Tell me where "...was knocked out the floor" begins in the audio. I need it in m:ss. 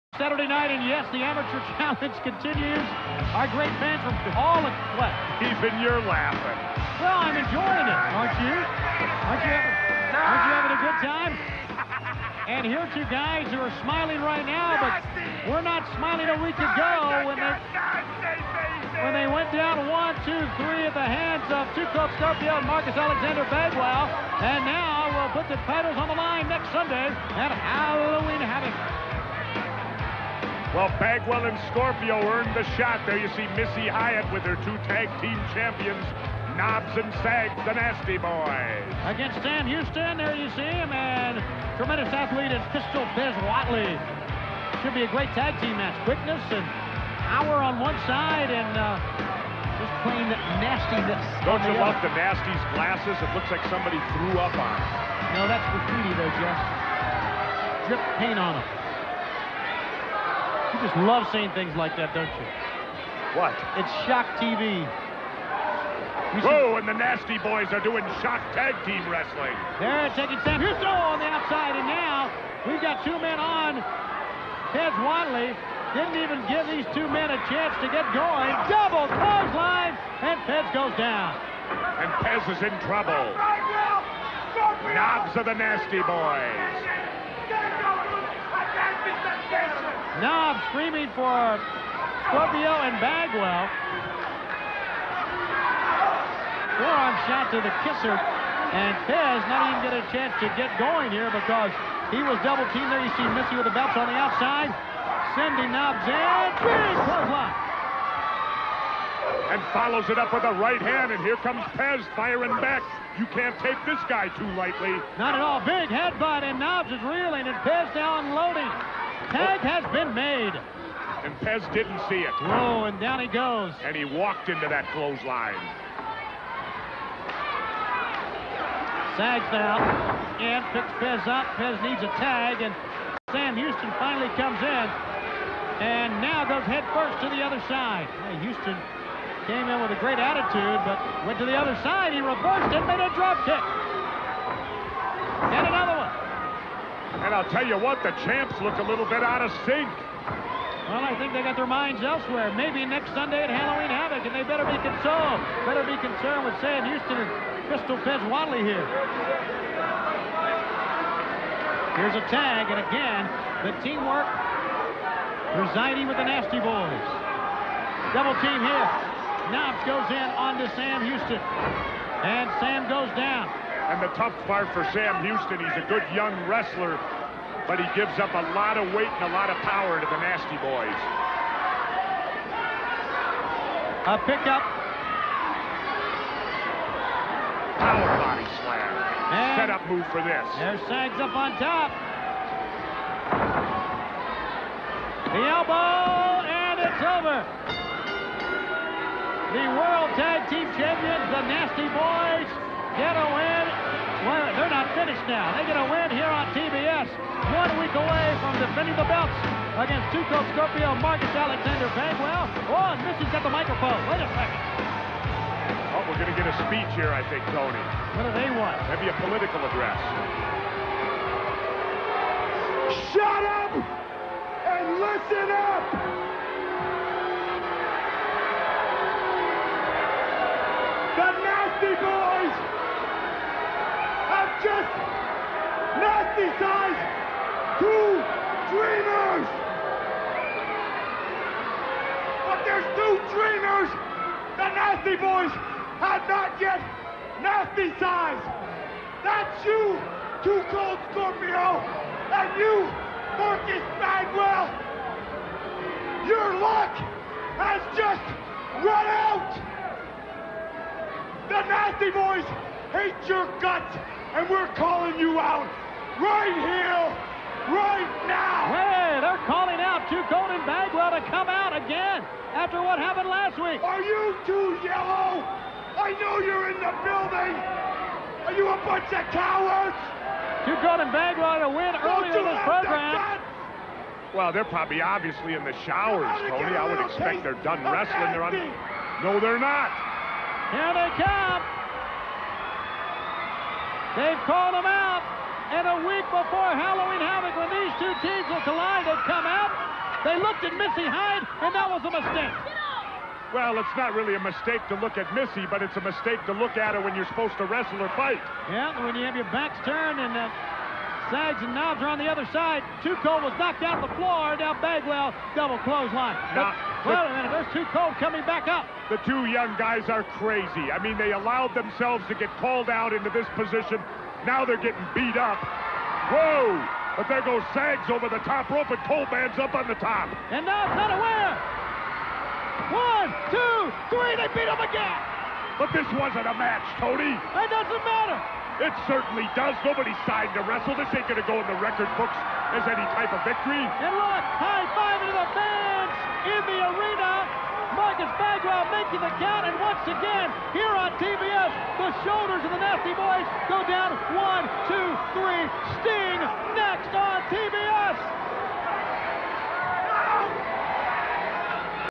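5:13.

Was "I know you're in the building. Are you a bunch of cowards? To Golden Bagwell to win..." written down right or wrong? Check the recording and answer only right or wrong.
right.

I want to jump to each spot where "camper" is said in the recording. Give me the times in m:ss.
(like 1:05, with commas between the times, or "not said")
not said.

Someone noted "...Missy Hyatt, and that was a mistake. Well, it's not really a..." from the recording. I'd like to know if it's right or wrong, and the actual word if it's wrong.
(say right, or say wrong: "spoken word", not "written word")
right.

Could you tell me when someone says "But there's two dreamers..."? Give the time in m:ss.
4:02.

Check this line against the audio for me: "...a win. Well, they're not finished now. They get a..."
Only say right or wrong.
right.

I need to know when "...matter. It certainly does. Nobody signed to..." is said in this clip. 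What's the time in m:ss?
5:38.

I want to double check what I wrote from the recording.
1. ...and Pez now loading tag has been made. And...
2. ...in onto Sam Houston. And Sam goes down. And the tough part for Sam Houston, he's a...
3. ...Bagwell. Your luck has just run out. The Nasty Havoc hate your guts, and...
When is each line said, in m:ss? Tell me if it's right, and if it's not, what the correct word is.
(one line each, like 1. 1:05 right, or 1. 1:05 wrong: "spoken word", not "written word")
1. 1:57 right
2. 2:50 right
3. 4:13 wrong: "Boys", not "Havoc".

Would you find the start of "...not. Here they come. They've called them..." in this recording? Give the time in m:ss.
4:49.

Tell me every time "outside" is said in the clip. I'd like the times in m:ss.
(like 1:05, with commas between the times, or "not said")
1:11, 1:44.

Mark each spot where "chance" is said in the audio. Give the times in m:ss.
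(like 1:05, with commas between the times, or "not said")
1:17, 1:40.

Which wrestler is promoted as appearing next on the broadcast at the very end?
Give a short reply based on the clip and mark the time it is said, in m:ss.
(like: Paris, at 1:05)
Sting, at 5:56.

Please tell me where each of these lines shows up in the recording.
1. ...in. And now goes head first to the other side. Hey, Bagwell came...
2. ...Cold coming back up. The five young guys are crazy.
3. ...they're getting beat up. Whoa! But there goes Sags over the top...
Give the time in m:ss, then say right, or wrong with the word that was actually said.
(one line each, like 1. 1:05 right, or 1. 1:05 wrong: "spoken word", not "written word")
1. 2:14 wrong: "Houston", not "Bagwell"
2. 5:17 wrong: "two", not "five"
3. 5:24 right.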